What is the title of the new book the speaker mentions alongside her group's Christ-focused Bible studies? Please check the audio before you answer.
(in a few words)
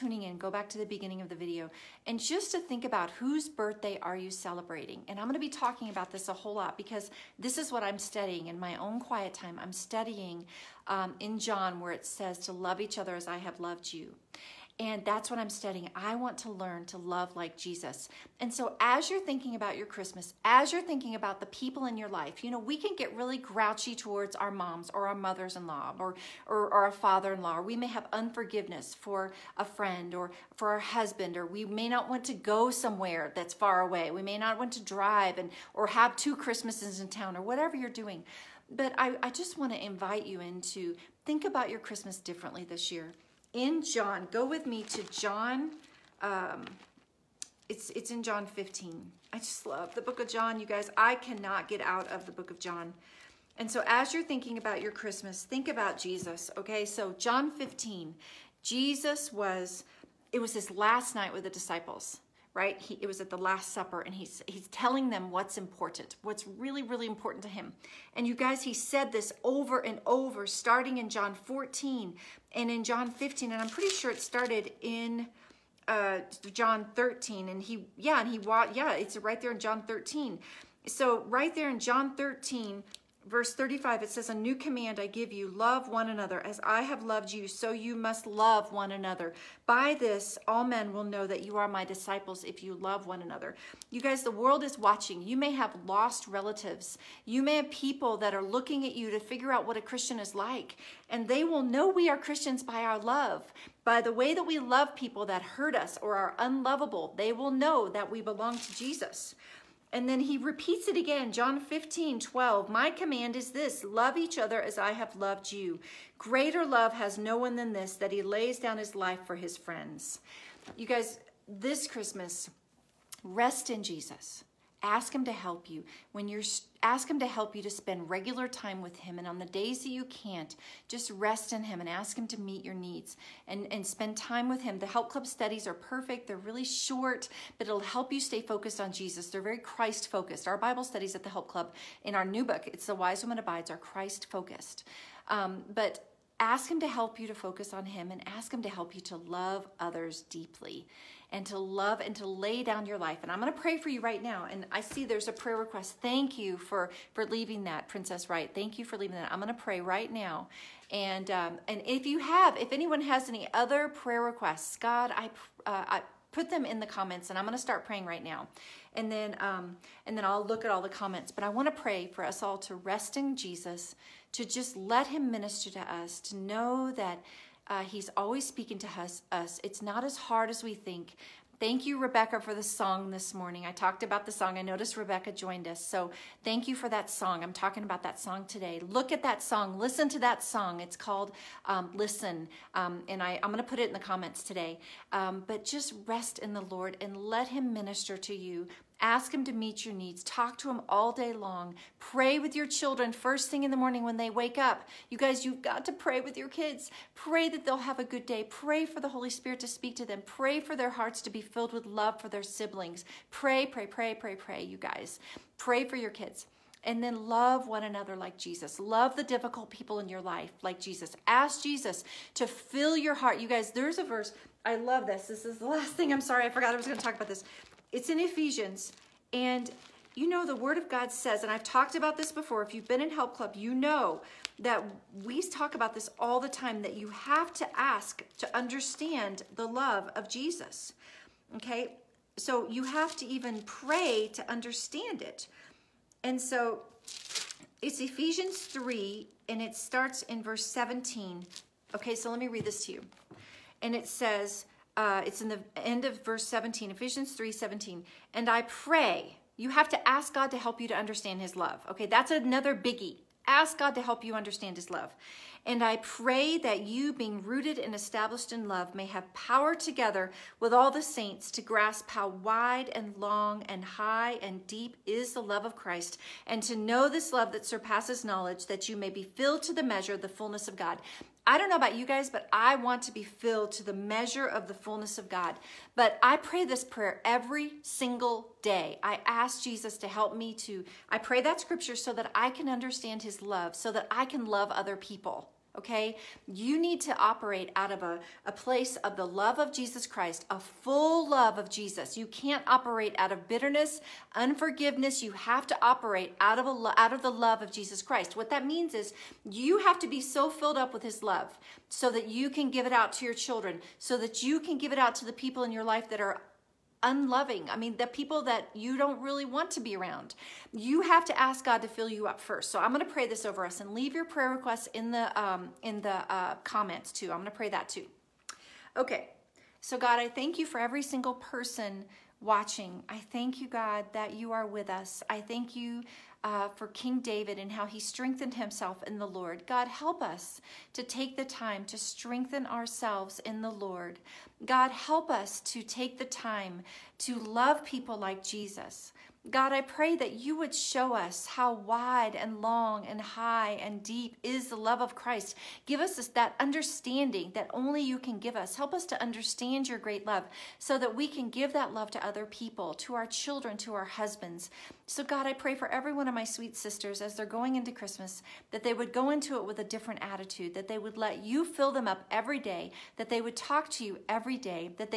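The Wise Woman Abides.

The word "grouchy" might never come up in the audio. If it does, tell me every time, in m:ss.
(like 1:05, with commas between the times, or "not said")
0:23.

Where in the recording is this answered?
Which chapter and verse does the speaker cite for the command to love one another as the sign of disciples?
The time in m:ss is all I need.
1:21.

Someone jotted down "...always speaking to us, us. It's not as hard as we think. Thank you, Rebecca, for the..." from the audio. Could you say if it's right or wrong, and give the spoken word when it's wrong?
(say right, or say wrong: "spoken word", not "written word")
right.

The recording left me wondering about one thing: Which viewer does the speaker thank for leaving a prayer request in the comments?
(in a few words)
Princess Right.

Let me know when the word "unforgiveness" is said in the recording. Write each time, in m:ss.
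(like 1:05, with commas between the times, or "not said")
0:28, 5:04.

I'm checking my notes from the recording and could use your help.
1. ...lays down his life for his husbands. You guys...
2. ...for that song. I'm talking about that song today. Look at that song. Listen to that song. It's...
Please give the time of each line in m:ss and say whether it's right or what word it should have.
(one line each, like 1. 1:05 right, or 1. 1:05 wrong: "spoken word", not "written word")
1. 1:58 wrong: "friends", not "husbands"
2. 3:06 right.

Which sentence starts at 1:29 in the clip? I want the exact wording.
By this, all men will know that you are my disciples if you love one another.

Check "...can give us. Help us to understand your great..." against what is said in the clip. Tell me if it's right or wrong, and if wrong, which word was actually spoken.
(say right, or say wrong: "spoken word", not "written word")
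right.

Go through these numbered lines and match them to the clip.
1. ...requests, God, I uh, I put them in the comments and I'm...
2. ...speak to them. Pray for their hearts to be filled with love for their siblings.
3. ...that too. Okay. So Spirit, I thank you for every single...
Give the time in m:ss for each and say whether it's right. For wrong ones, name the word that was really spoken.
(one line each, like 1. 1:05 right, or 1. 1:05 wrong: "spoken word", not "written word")
1. 2:44 right
2. 3:29 right
3. 5:27 wrong: "God", not "Spirit".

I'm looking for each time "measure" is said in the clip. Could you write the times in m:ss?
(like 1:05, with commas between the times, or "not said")
4:39, 4:43.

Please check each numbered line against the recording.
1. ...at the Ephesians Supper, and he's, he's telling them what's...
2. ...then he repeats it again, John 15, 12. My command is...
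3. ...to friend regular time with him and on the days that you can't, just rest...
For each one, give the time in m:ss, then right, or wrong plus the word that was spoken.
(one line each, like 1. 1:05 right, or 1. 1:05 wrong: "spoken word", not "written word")
1. 1:03 wrong: "Last", not "Ephesians"
2. 1:50 right
3. 2:07 wrong: "spend", not "friend".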